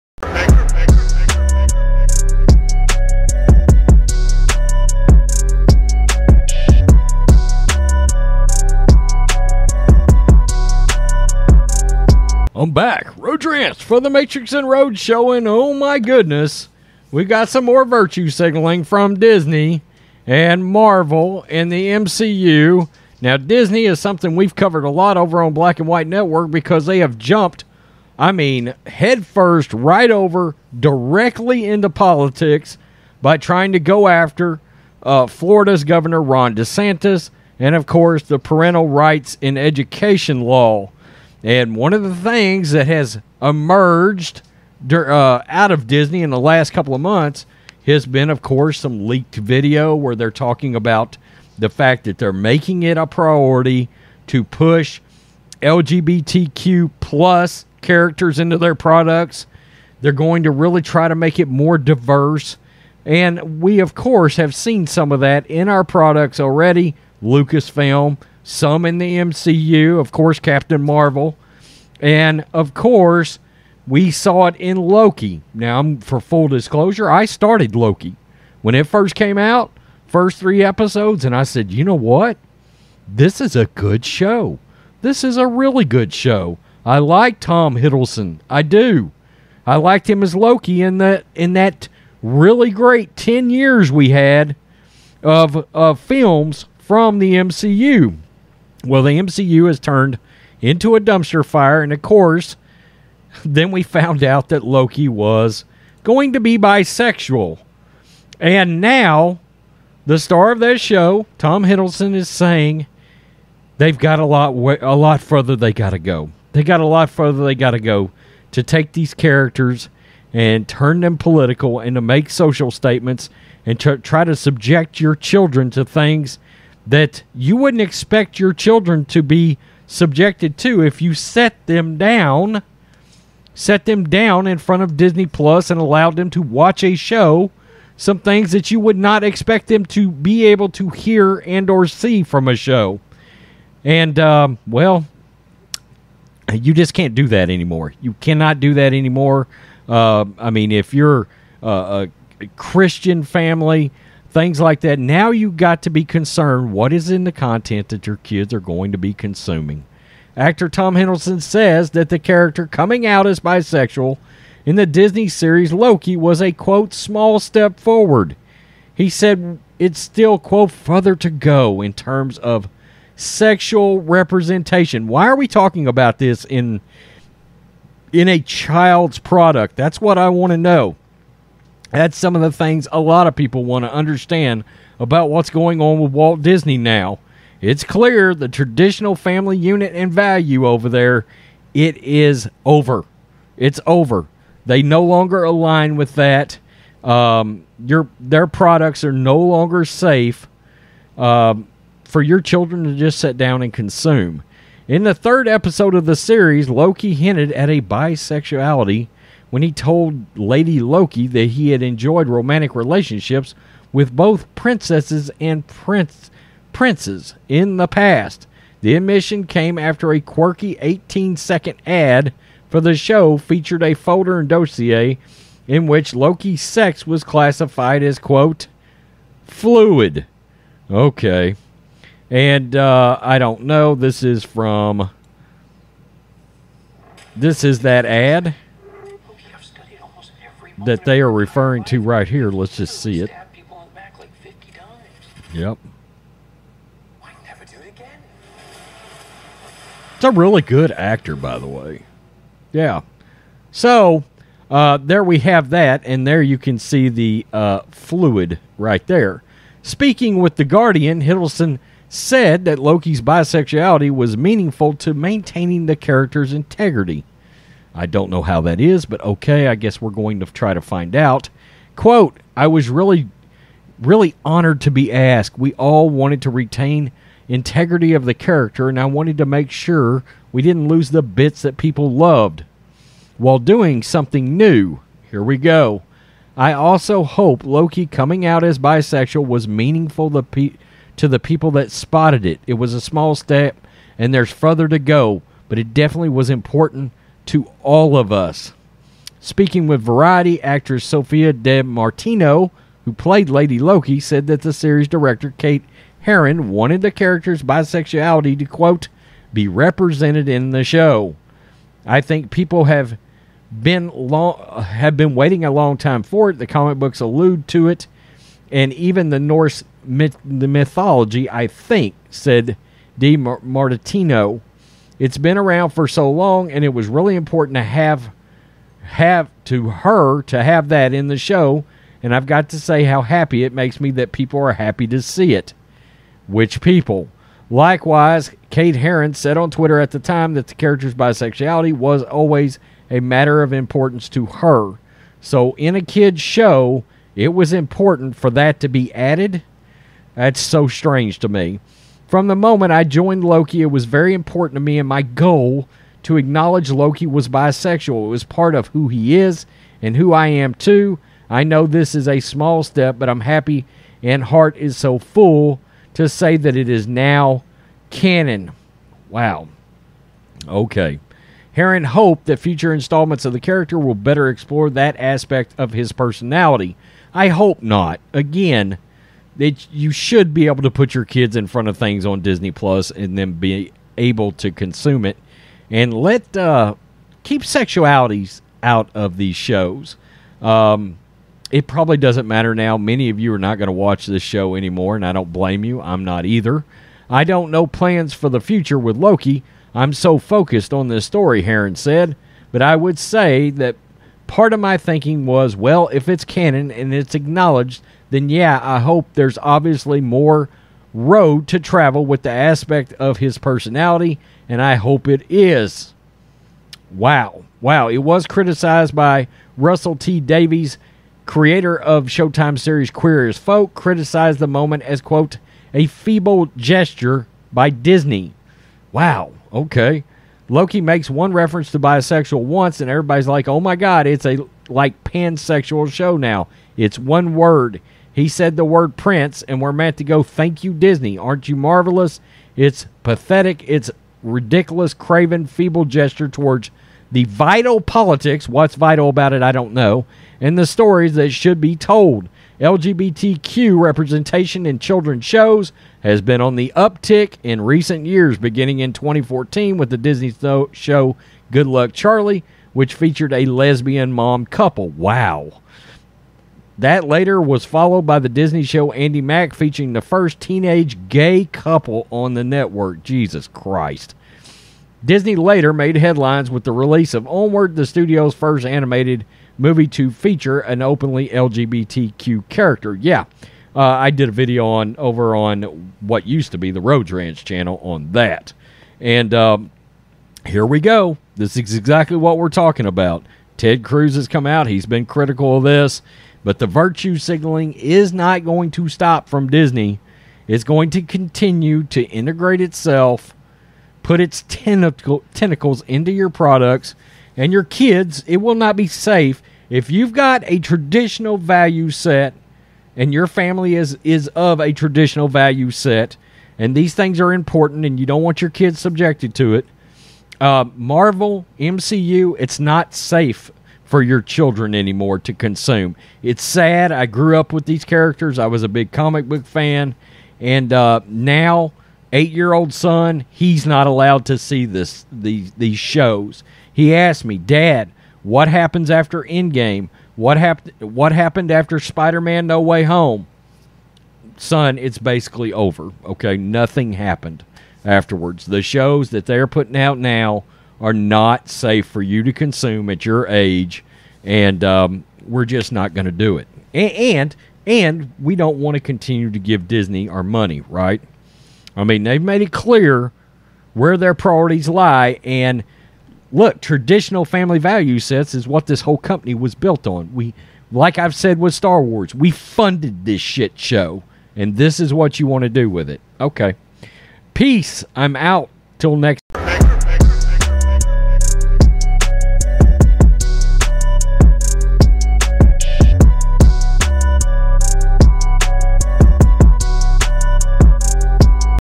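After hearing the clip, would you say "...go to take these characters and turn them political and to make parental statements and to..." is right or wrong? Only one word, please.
wrong.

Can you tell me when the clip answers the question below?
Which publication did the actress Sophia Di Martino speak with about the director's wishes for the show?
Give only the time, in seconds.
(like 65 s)
300 s.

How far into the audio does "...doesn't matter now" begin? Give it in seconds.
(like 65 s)
392 s.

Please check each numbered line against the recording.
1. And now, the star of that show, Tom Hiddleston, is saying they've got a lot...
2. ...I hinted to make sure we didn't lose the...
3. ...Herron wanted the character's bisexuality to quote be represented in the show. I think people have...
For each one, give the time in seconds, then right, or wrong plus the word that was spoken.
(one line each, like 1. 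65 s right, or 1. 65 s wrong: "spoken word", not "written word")
1. 108 s right
2. 278 s wrong: "wanted", not "hinted"
3. 306 s right.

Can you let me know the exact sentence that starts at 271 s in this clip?
Quote, I was really, really honored to be asked.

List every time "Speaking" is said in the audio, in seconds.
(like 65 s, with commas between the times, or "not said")
259 s, 299 s.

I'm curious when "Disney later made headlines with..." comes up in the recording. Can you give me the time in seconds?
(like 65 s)
475 s.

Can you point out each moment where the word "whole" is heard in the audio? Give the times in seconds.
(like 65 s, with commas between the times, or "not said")
569 s.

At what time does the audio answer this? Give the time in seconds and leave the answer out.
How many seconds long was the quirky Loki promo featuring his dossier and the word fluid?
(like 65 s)
220 s.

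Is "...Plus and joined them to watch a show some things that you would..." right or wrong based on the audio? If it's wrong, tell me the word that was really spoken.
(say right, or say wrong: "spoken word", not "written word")
wrong: "allowed", not "joined".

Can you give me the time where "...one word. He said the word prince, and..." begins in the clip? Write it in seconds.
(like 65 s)
437 s.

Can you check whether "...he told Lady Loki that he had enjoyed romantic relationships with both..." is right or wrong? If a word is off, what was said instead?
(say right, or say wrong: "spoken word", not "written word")
right.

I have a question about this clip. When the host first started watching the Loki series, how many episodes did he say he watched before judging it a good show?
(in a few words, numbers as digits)
3.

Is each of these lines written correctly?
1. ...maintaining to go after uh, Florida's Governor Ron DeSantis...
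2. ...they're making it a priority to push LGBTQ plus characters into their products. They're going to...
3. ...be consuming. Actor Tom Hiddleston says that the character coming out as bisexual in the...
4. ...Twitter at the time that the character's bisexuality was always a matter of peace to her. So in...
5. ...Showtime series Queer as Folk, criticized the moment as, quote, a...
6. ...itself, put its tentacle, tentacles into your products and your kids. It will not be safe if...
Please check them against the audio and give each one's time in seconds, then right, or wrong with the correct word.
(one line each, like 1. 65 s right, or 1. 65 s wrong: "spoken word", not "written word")
1. 33 s wrong: "trying", not "maintaining"
2. 52 s right
3. 158 s right
4. 339 s wrong: "importance", not "peace"
5. 422 s right
6. 502 s right.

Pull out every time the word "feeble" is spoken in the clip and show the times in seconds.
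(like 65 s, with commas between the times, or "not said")
426 s, 445 s.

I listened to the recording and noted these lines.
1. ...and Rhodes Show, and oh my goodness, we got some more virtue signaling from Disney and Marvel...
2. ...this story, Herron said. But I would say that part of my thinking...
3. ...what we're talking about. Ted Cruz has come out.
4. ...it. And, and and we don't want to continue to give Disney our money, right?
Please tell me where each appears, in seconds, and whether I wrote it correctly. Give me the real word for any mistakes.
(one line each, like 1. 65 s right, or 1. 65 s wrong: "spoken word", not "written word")
1. 14 s right
2. 401 s right
3. 492 s right
4. 556 s right.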